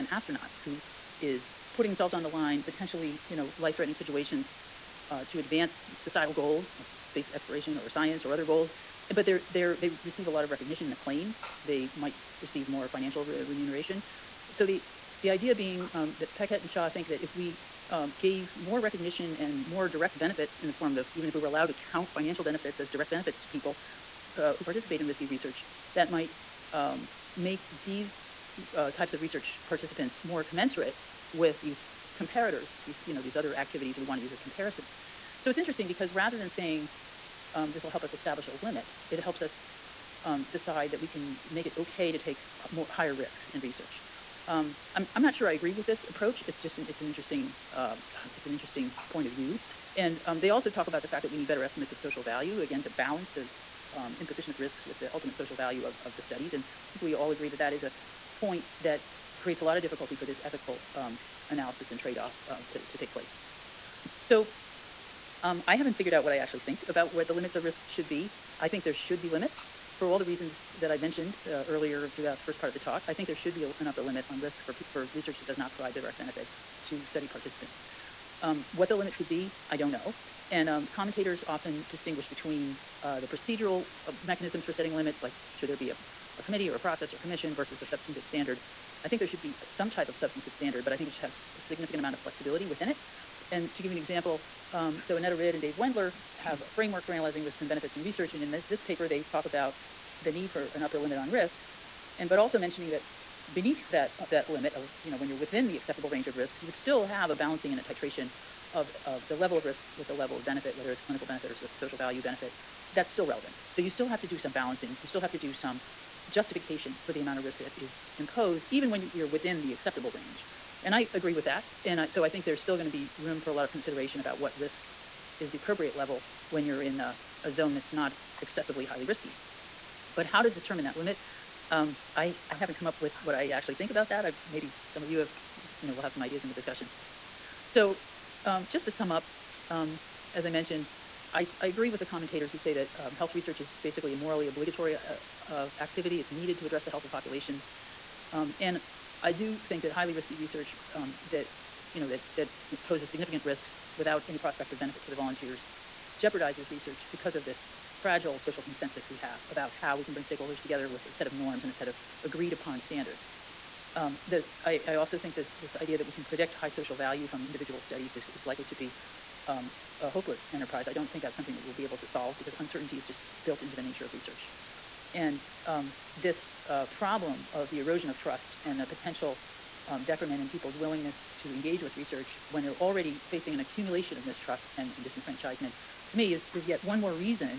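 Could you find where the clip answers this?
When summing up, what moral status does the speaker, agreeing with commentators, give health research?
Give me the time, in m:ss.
2:24.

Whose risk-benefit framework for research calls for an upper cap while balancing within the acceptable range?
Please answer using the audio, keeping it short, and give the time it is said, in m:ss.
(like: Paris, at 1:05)
Annette Rid and Dave Wendler, at 1:35.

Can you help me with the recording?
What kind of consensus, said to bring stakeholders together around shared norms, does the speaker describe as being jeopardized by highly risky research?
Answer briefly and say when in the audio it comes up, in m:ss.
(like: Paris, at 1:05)
fragile social consensus, at 2:38.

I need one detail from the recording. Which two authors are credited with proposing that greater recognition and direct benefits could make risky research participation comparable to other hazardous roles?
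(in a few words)
Beckett and Shah.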